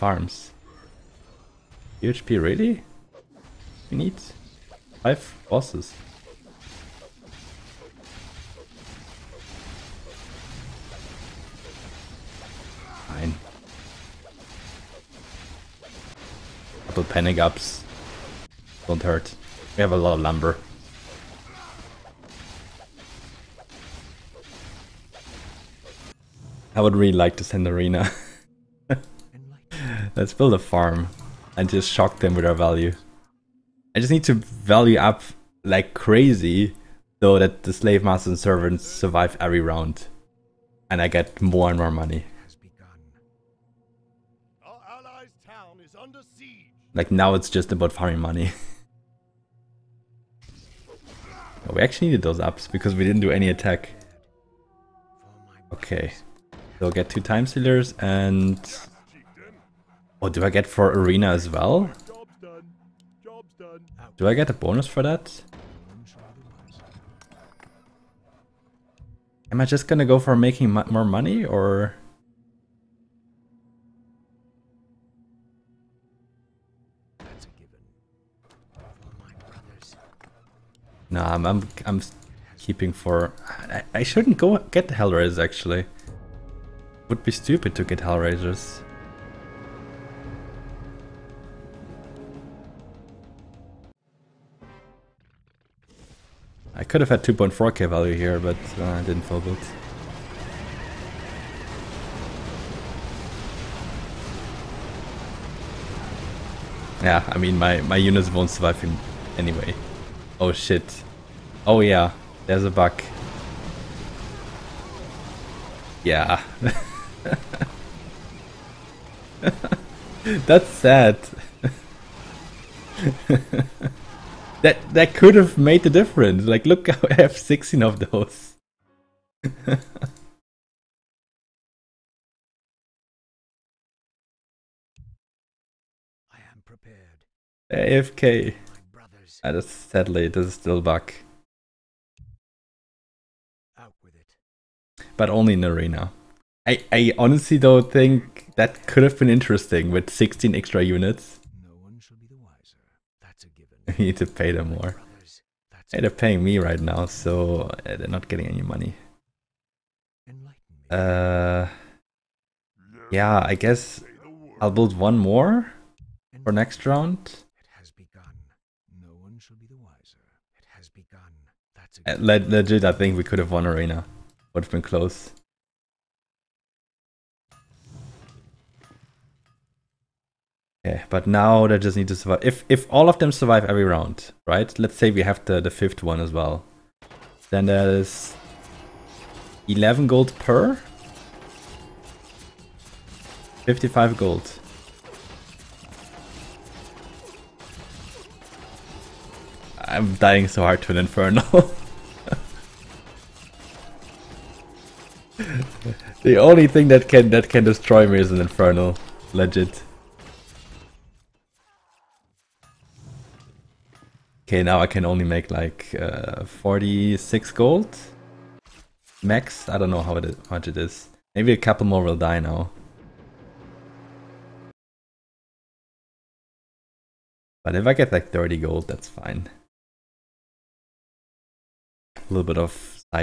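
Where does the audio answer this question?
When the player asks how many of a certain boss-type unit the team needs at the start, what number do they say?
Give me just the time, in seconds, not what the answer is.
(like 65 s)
5 s.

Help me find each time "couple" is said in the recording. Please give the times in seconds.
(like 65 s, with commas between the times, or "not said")
16 s, 221 s.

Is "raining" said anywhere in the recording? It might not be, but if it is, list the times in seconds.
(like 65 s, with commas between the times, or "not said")
not said.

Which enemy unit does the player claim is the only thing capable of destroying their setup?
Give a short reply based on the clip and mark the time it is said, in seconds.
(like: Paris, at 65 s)
Infernal, at 208 s.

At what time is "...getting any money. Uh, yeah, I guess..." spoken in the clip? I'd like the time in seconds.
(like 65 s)
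158 s.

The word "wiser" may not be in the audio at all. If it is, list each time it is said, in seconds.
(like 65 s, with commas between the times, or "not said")
152 s, 169 s.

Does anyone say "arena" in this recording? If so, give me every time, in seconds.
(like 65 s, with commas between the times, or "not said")
27 s, 60 s, 145 s, 173 s.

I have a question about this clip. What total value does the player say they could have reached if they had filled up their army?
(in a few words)
2.4k.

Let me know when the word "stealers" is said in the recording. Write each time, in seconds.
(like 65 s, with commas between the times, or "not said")
57 s.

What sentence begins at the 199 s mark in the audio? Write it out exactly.
I'm dying so hard to an Inferno.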